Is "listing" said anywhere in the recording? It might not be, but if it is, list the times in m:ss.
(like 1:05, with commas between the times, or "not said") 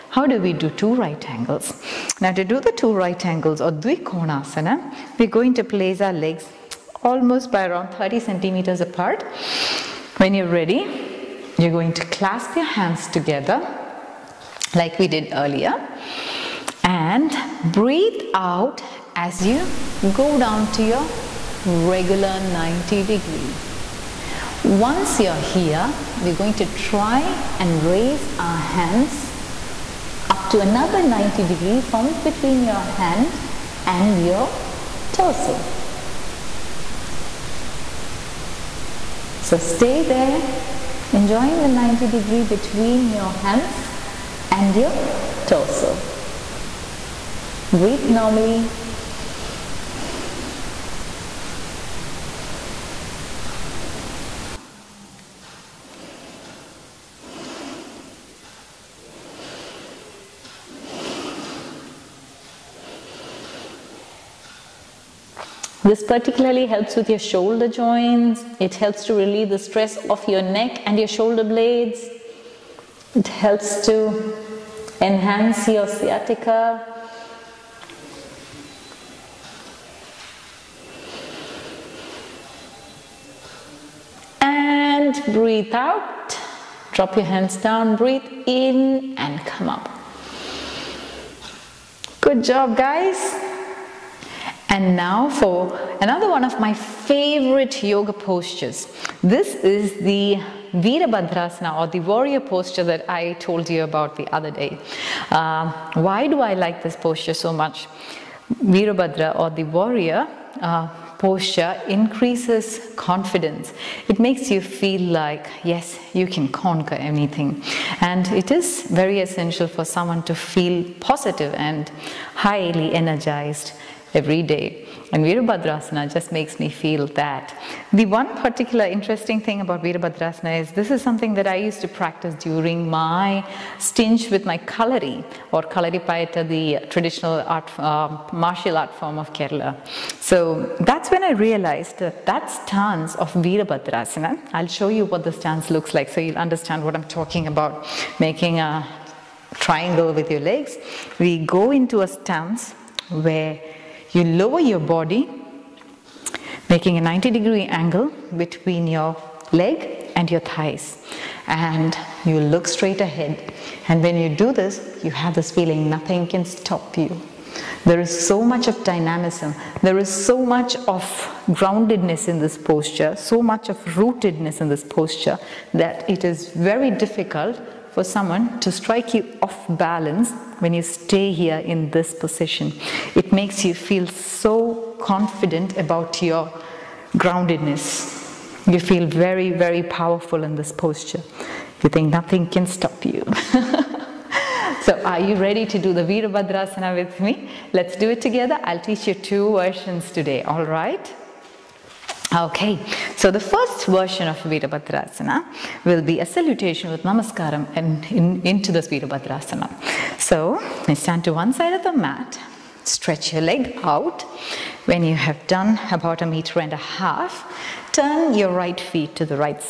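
not said.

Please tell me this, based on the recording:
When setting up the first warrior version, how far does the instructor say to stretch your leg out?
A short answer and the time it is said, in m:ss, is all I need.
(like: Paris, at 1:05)
1.5 meters, at 3:36.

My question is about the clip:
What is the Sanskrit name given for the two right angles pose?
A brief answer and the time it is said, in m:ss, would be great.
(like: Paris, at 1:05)
Dvikonasana, at 0:03.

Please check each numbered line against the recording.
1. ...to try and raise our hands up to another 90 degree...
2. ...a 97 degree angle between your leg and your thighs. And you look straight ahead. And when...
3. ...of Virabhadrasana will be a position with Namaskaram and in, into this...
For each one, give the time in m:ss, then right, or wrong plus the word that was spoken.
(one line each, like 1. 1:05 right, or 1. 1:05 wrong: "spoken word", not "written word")
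1. 0:26 right
2. 2:36 wrong: "90", not "97"
3. 3:24 wrong: "salutation", not "position".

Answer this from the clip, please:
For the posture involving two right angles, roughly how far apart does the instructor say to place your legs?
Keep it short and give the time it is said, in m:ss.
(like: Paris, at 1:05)
30 centimeters, at 0:07.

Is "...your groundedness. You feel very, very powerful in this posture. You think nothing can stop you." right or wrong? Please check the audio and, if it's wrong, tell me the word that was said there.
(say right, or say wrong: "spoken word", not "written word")
right.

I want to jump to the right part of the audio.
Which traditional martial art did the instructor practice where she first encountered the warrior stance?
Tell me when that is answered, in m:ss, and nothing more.
2:15.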